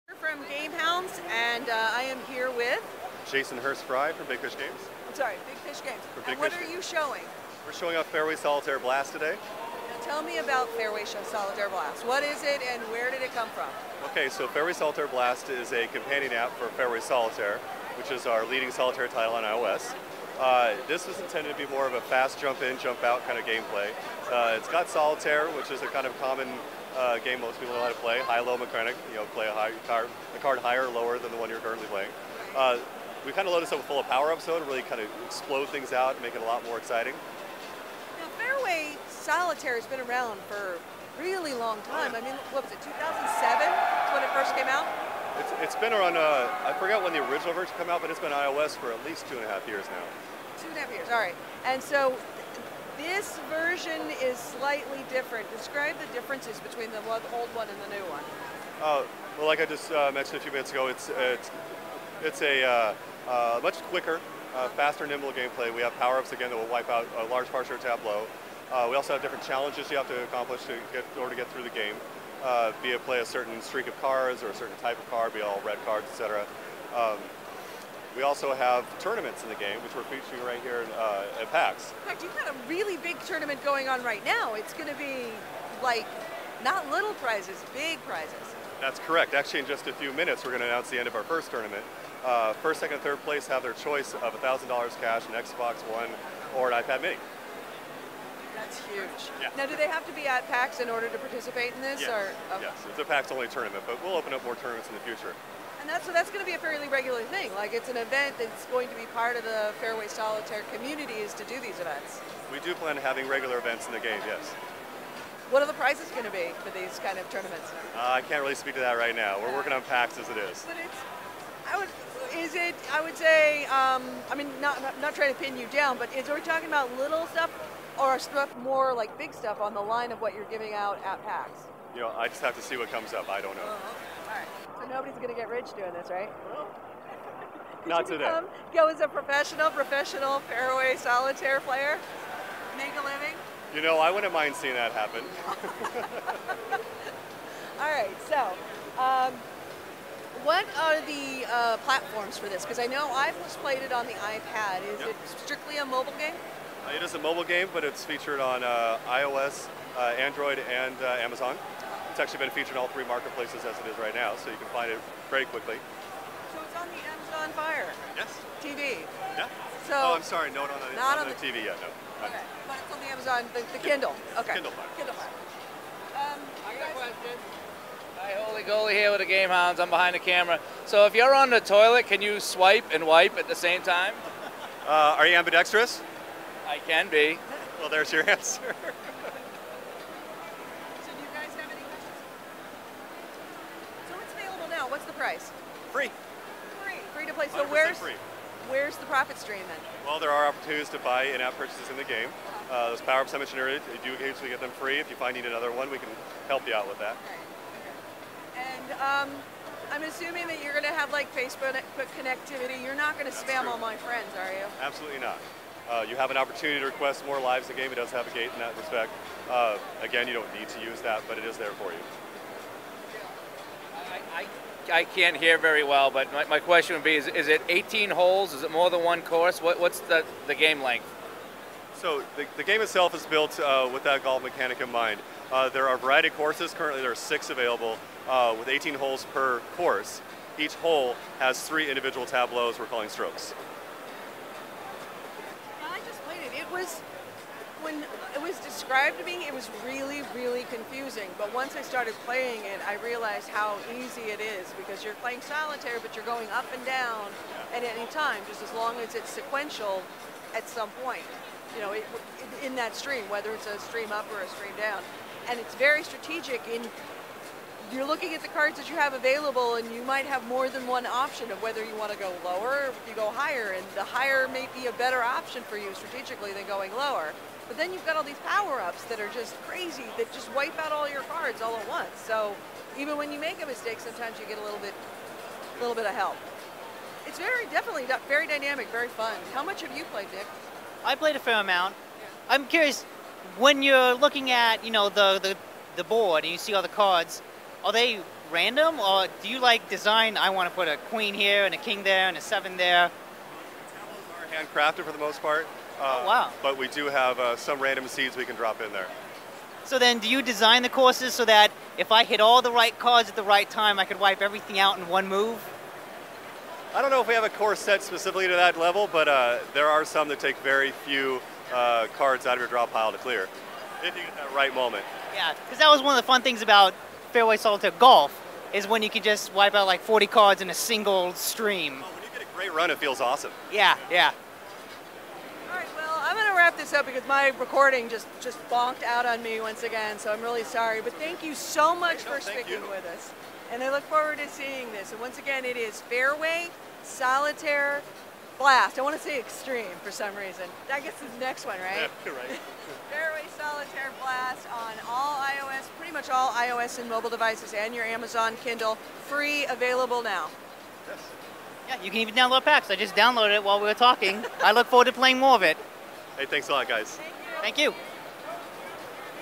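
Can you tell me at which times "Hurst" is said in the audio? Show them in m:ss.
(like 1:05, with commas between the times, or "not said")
0:03.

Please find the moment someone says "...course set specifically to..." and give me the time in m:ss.
5:17.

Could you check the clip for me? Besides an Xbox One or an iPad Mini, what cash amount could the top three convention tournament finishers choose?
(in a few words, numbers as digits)
$1,000.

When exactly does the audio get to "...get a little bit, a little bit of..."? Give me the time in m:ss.
4:44.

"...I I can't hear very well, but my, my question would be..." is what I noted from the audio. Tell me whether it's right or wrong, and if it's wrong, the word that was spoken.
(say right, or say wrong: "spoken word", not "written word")
right.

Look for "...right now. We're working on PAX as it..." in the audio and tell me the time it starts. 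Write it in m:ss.
1:58.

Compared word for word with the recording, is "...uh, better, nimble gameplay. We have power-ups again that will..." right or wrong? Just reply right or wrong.
wrong.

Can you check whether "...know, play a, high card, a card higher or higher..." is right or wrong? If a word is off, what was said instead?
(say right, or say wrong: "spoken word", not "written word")
wrong: "lower", not "higher".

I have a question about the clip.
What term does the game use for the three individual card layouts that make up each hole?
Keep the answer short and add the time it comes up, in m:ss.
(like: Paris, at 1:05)
strokes, at 4:03.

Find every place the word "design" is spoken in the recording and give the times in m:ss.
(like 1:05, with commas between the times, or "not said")
4:59, 5:10.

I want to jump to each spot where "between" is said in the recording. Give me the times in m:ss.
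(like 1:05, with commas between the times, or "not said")
0:56.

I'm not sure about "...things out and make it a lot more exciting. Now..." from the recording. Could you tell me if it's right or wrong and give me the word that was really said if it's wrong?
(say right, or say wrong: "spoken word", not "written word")
right.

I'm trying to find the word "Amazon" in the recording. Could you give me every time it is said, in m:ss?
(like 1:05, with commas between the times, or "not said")
2:41, 2:47, 2:53, 5:58.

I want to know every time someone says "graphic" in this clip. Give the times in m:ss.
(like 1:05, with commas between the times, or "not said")
not said.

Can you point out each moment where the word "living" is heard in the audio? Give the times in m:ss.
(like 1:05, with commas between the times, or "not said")
2:23.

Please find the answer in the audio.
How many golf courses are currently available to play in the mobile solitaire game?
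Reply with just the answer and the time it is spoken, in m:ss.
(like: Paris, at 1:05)
6, at 3:57.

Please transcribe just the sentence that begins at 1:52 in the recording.
We do plan on having regular events in the game, yes.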